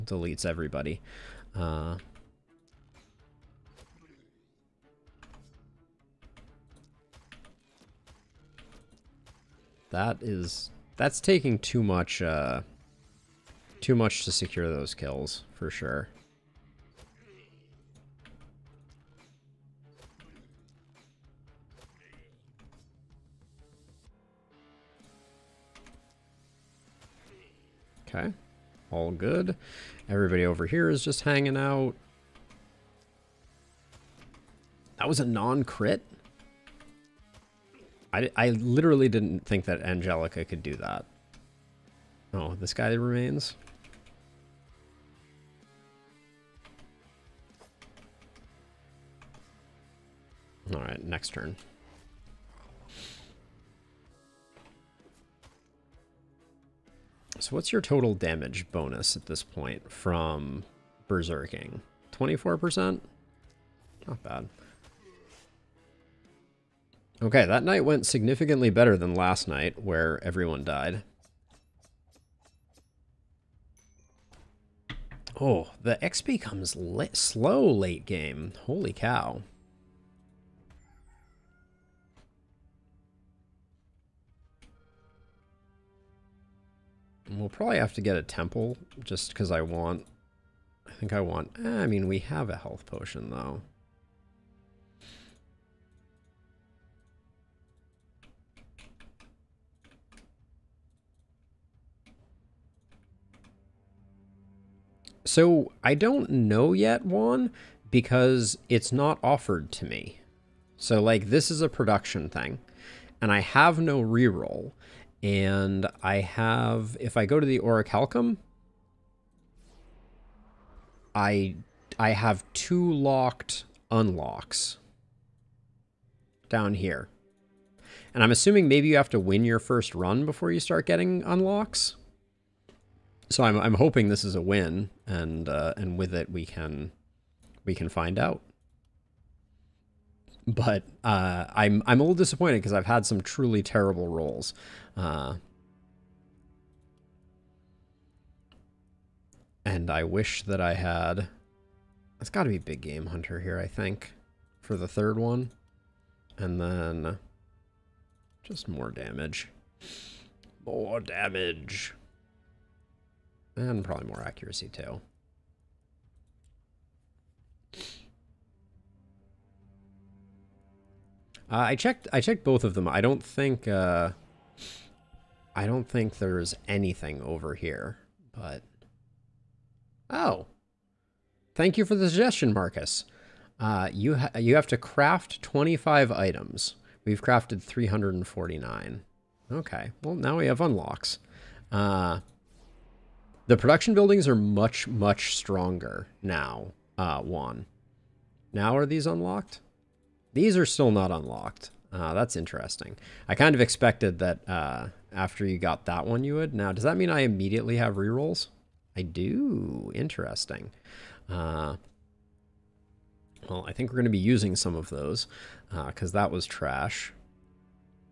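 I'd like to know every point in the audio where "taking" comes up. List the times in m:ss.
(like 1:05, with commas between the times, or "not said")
0:11.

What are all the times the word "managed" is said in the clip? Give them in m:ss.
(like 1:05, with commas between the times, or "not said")
not said.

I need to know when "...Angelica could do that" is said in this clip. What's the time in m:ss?
0:39.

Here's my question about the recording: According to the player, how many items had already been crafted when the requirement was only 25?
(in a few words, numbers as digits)
349.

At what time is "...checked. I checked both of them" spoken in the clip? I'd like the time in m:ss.
2:51.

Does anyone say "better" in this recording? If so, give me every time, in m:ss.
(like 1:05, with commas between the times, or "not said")
1:08.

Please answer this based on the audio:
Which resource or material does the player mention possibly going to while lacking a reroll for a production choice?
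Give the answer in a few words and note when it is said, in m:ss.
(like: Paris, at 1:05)
Orichalcum, at 1:57.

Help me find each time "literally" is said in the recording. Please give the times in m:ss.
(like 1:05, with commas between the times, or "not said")
0:38.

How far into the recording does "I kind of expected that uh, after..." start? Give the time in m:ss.
3:23.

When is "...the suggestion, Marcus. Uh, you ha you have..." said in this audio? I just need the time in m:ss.
3:01.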